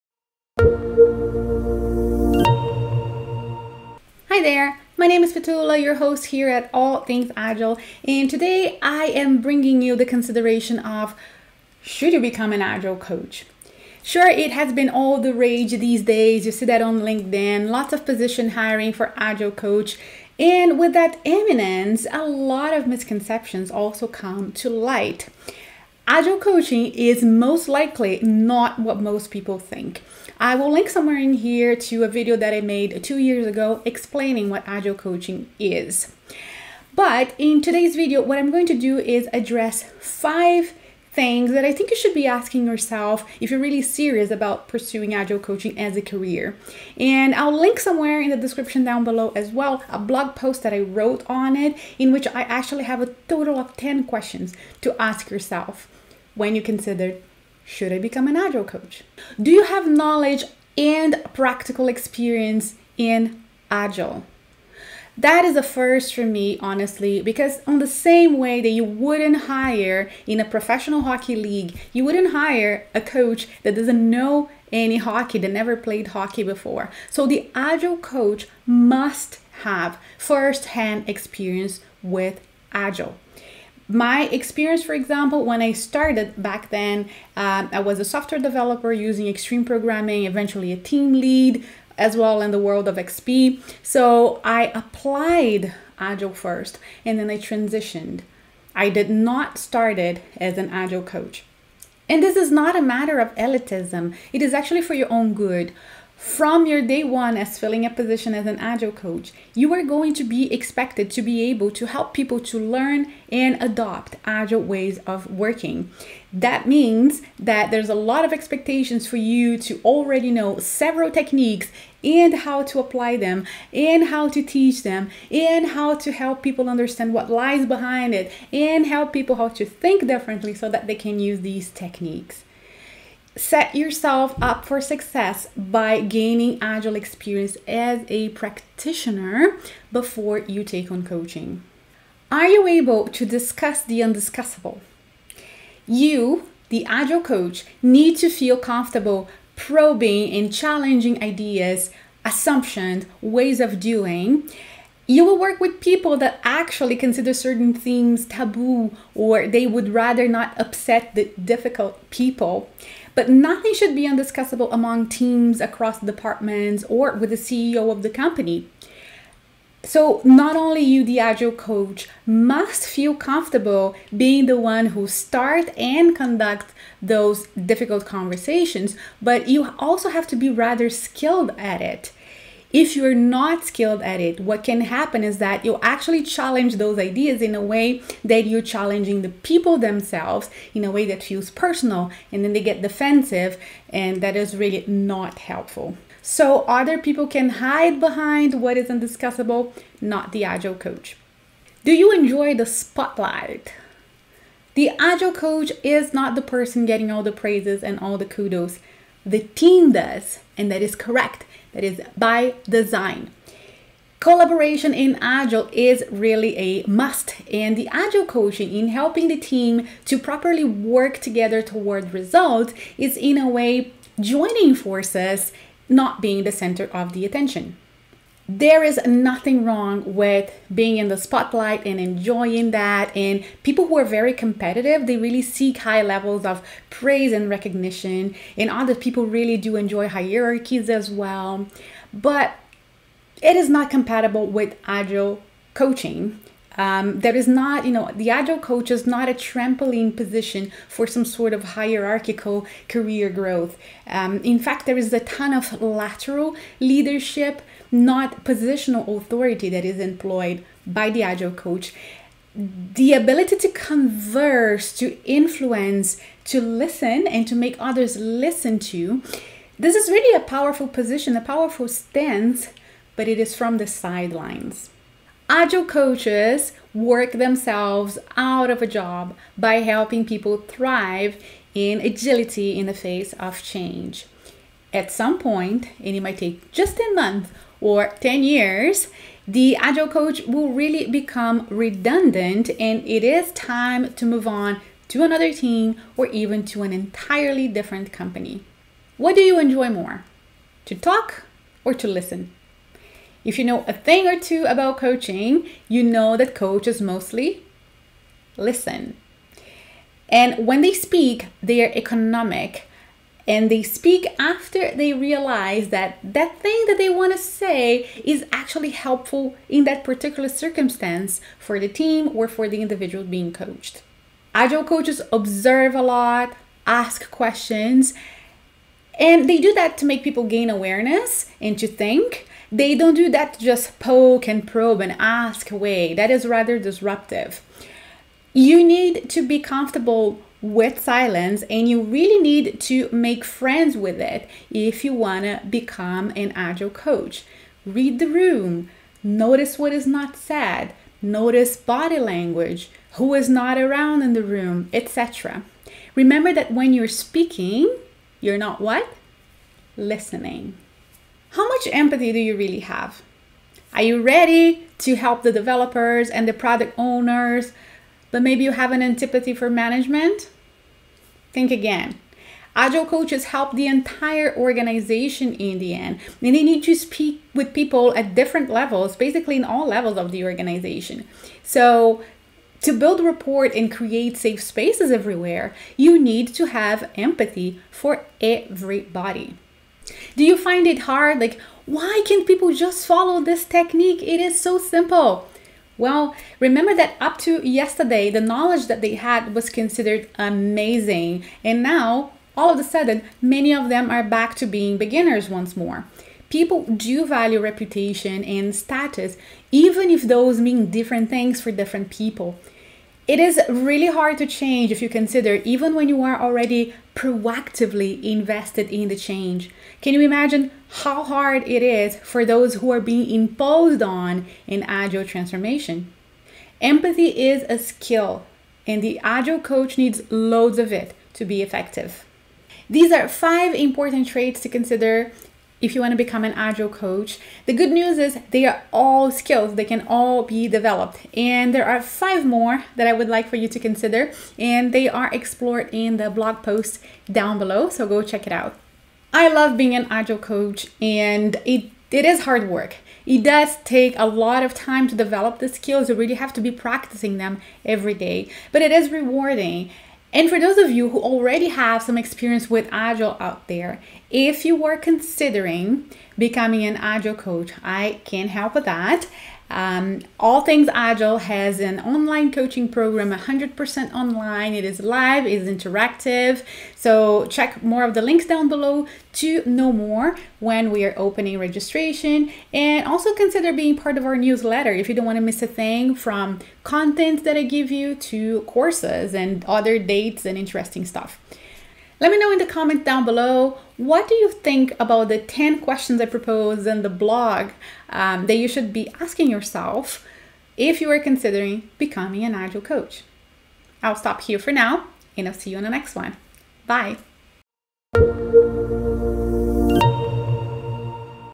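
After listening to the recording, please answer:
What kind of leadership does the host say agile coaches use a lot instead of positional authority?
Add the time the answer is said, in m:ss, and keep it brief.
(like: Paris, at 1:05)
Lateral leadership, at 4:15.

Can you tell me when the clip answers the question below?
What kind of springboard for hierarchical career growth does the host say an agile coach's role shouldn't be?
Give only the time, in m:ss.
4:09.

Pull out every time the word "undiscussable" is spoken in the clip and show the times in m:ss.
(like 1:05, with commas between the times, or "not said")
2:24, 2:44, 3:18.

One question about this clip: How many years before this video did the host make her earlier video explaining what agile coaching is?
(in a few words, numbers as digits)
2.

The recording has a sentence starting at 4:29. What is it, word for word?
This is really a powerful position, a powerful stance, but it is from the sidelines.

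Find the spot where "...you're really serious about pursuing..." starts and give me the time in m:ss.
0:43.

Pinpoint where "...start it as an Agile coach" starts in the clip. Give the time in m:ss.
1:39.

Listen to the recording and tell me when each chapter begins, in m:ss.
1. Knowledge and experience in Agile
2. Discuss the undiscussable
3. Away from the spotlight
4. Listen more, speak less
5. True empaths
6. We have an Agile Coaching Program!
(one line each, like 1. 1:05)
1. 0:59
2. 2:22
3. 3:22
4. 4:59
5. 6:01
6. 7:40.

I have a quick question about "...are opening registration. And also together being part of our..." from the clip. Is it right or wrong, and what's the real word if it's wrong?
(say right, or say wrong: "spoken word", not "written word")
wrong: "consider", not "together".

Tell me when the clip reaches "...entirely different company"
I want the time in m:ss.
4:56.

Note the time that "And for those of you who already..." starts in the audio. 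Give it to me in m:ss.
7:40.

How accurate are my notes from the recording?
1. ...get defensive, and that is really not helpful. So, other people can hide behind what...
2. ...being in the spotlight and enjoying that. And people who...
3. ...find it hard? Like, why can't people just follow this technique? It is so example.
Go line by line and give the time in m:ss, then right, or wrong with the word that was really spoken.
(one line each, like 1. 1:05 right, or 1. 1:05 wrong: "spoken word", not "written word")
1. 3:12 right
2. 3:50 right
3. 6:30 wrong: "simple", not "example".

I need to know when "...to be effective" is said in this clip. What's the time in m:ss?
7:11.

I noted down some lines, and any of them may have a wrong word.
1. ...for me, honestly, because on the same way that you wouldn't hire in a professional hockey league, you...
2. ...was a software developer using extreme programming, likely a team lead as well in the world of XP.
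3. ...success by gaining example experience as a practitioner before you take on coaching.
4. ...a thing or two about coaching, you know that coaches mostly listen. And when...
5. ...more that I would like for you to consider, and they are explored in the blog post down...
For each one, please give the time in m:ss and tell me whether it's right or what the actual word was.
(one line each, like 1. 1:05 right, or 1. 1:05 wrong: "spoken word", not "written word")
1. 1:06 right
2. 1:27 wrong: "eventually", not "likely"
3. 2:14 wrong: "agile", not "example"
4. 5:03 right
5. 7:22 right.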